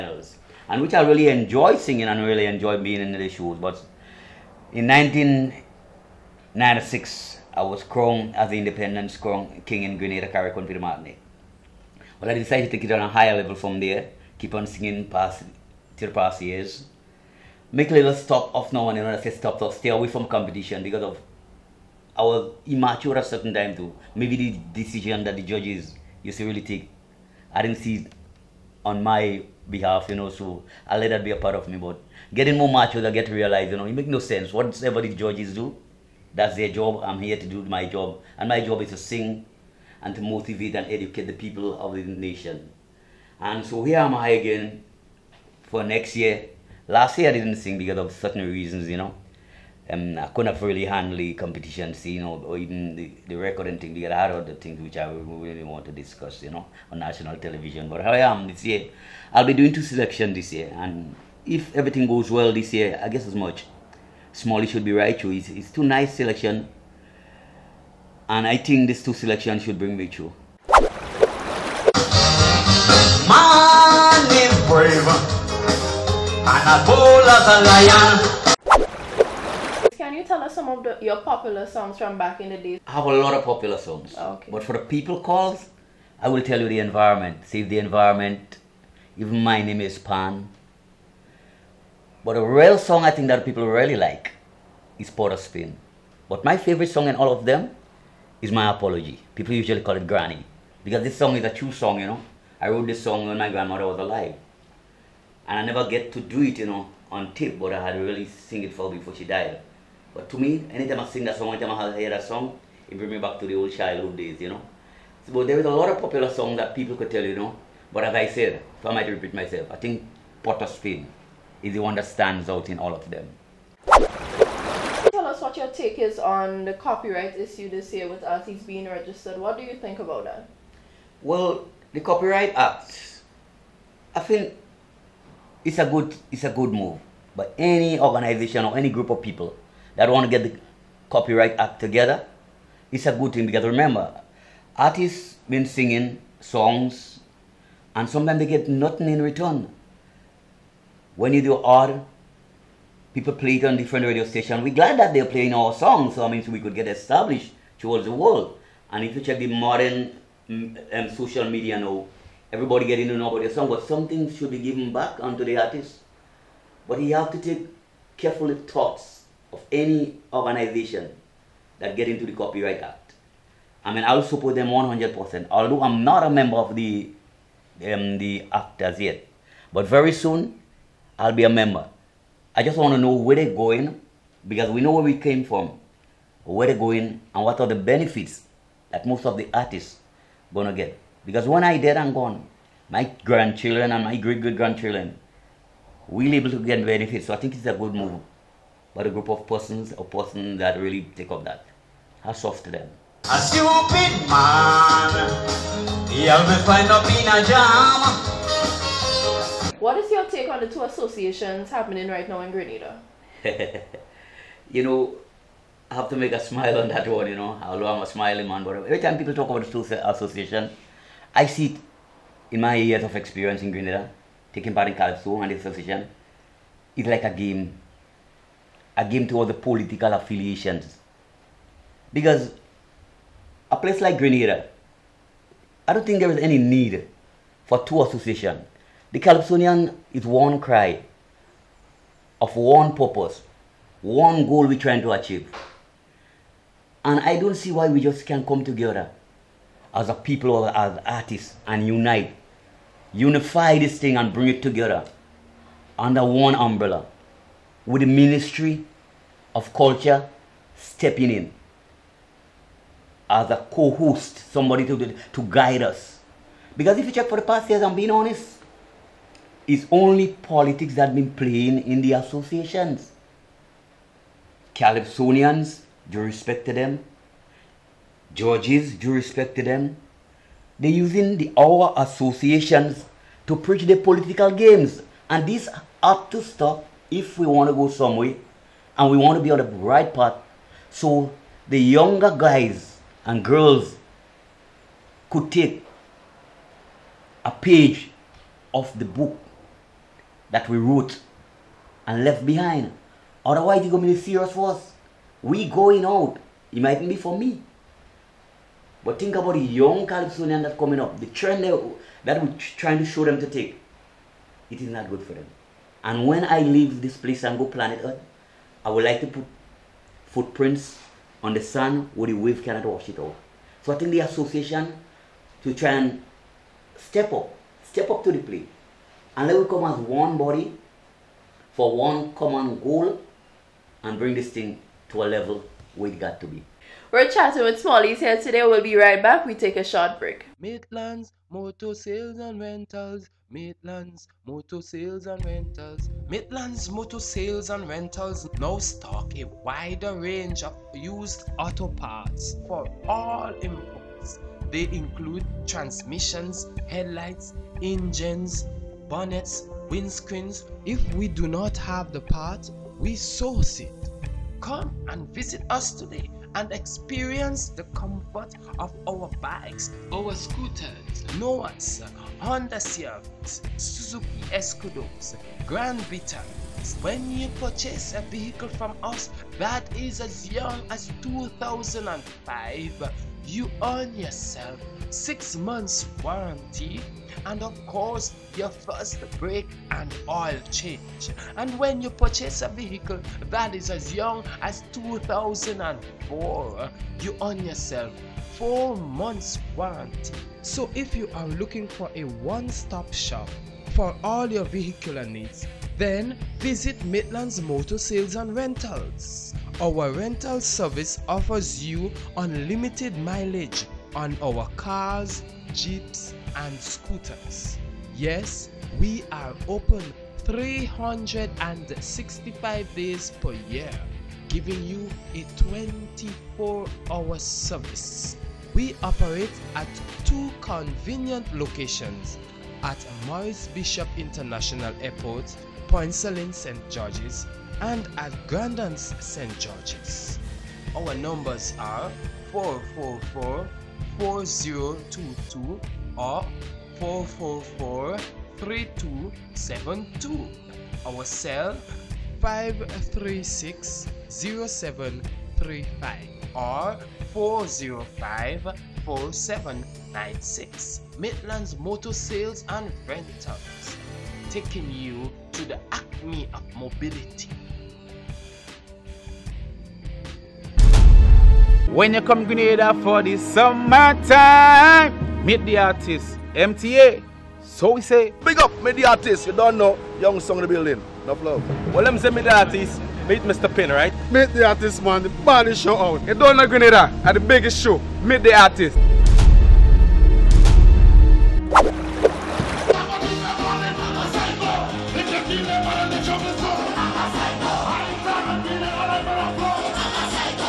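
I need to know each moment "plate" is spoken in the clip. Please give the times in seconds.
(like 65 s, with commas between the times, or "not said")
328 s.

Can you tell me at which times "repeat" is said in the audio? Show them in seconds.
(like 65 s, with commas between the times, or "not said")
119 s.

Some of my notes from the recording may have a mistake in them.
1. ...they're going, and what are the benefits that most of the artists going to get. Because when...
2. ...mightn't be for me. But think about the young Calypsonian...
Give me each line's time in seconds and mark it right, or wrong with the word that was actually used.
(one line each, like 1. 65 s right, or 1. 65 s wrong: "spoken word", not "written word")
1. 186 s right
2. 306 s right.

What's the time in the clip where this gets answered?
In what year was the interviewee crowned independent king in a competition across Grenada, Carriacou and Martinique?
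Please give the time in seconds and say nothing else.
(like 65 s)
4 s.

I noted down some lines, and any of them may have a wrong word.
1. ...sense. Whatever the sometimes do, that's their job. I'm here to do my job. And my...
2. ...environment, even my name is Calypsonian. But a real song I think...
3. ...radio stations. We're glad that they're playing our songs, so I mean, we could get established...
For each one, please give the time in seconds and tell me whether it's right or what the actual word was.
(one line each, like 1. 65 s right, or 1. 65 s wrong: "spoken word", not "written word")
1. 34 s wrong: "judges", not "sometimes"
2. 87 s wrong: "Pan", not "Calypsonian"
3. 154 s right.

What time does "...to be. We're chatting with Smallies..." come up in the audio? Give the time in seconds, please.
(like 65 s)
336 s.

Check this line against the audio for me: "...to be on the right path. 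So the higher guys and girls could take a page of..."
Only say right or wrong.
wrong.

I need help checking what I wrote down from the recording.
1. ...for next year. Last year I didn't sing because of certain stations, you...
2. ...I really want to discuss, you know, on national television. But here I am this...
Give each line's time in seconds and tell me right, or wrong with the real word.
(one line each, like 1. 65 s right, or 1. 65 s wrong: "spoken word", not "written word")
1. 45 s wrong: "reasons", not "stations"
2. 54 s right.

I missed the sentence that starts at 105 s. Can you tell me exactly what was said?
And I never get to do it, you know, on tape, but I had really sing it for her before she died.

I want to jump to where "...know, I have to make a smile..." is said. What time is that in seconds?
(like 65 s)
214 s.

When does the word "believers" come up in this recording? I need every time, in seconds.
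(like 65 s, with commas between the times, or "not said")
not said.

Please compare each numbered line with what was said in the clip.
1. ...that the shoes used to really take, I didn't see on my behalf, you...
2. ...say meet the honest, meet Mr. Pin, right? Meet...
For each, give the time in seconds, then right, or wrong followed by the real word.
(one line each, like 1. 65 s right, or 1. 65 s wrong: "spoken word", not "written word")
1. 25 s wrong: "judges", not "shoes"
2. 482 s wrong: "artist", not "honest".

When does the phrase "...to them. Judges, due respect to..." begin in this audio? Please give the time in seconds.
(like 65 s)
276 s.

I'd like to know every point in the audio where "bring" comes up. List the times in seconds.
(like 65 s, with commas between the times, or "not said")
69 s, 112 s, 254 s, 334 s.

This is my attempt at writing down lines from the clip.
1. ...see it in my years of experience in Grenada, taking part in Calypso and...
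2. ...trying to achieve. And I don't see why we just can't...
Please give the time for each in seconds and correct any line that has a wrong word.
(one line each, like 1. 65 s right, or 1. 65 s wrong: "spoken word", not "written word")
1. 221 s right
2. 244 s right.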